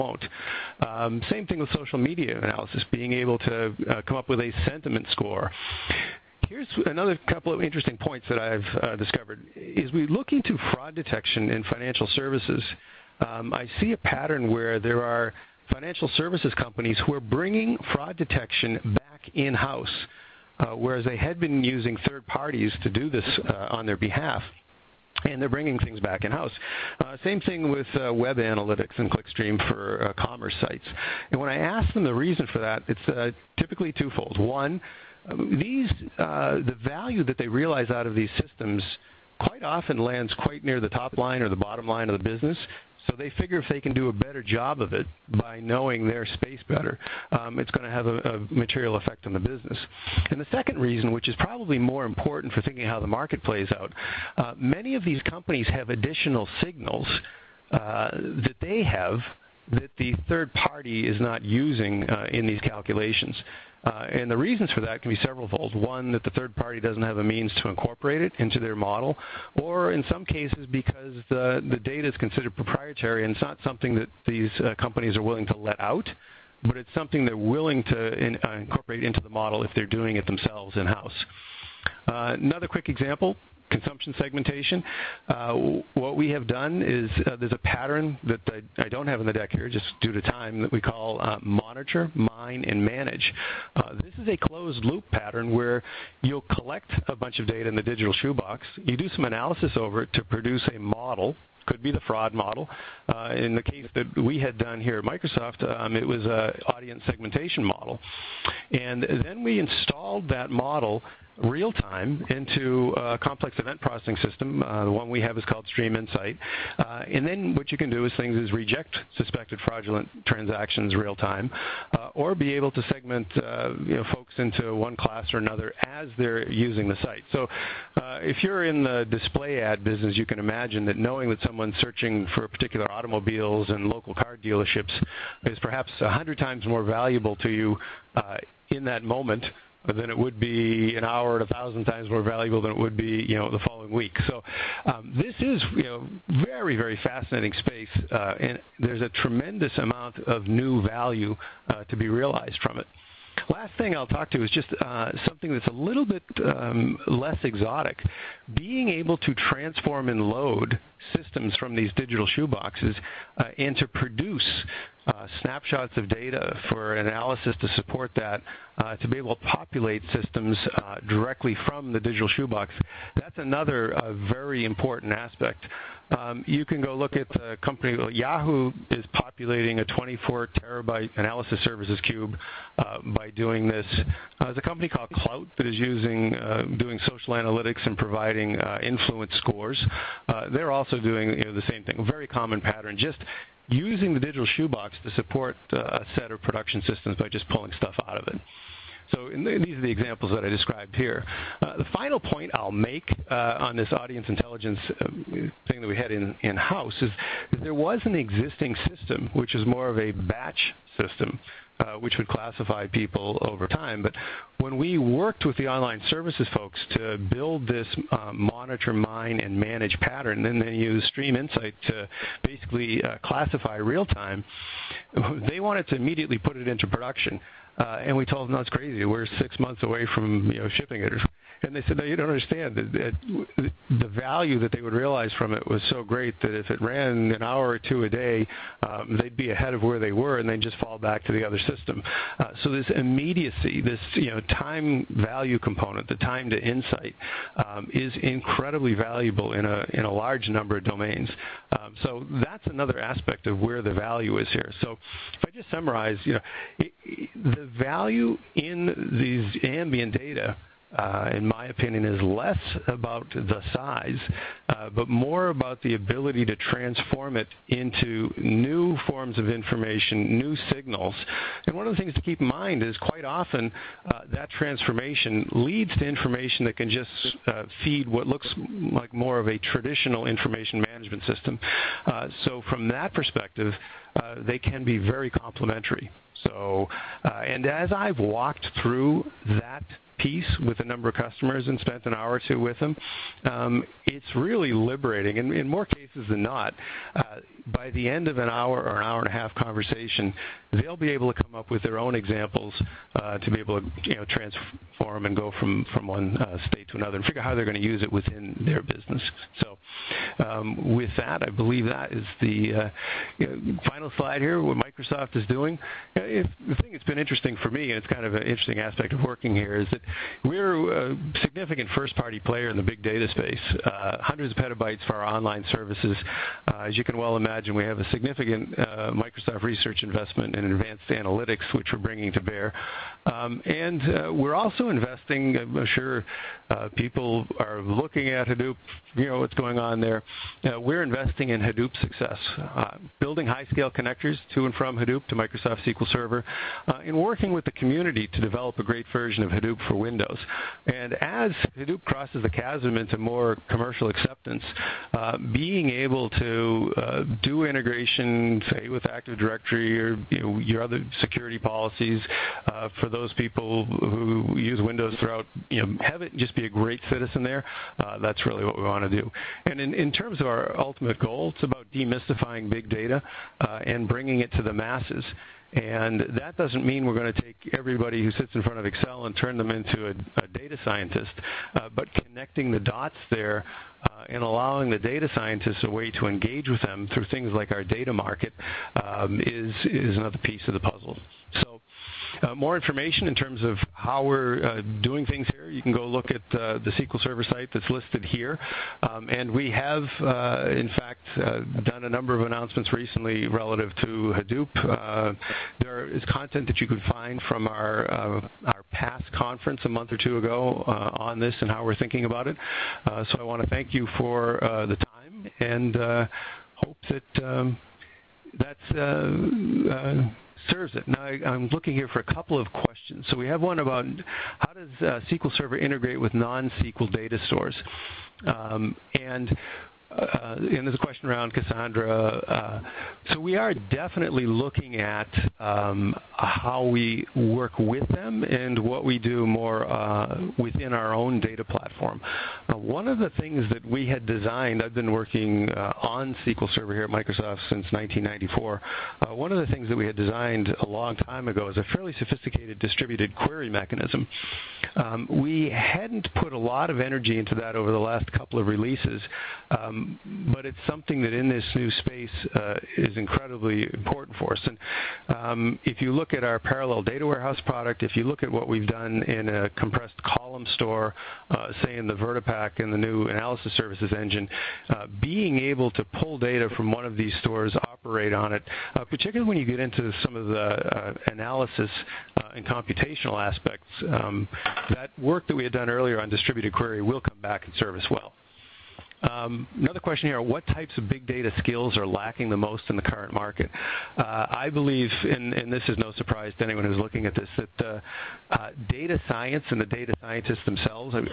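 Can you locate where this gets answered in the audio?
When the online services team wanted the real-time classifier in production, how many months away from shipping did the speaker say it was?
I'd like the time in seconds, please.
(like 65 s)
229 s.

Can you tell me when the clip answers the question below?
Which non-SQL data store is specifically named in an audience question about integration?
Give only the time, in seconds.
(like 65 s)
431 s.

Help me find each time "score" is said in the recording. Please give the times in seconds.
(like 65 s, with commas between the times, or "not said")
5 s, 189 s.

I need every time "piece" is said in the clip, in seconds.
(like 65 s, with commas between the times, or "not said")
290 s, 390 s.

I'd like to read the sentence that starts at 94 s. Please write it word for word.
This is a closed loop pattern where you'll collect a bunch of data in the digital shoebox.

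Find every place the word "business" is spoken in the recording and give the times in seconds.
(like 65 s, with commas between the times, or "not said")
42 s, 49 s, 129 s, 308 s.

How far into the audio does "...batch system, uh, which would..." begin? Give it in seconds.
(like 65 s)
210 s.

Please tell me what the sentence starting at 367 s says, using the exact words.
Uh, that's really what we want to do.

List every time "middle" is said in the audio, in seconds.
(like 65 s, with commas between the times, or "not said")
not said.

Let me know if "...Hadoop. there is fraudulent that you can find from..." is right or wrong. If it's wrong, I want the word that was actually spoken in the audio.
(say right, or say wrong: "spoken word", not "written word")
wrong: "content", not "fraudulent".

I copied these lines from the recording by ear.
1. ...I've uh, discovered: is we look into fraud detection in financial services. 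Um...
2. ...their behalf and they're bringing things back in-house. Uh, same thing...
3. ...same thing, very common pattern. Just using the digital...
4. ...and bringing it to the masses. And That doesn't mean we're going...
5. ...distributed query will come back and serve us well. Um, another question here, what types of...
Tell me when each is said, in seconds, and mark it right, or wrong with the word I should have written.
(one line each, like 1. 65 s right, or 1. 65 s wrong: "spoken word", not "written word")
1. 8 s right
2. 23 s right
3. 191 s right
4. 373 s right
5. 486 s right.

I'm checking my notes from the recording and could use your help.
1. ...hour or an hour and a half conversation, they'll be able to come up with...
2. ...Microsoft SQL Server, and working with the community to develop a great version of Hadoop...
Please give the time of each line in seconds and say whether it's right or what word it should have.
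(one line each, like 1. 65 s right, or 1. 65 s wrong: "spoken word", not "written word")
1. 298 s right
2. 345 s right.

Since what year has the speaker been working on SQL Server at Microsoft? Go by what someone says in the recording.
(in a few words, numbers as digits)
1994.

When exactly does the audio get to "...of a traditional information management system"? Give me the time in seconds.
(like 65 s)
279 s.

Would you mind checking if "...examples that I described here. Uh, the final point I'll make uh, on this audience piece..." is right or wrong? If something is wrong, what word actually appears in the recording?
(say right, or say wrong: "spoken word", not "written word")
wrong: "intelligence", not "piece".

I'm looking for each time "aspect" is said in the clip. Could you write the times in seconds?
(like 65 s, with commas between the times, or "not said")
175 s, 252 s, 318 s, 483 s.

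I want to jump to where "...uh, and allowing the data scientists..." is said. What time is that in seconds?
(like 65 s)
384 s.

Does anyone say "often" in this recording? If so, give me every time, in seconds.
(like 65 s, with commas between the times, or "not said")
39 s, 273 s.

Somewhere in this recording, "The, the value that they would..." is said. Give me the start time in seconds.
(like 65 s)
232 s.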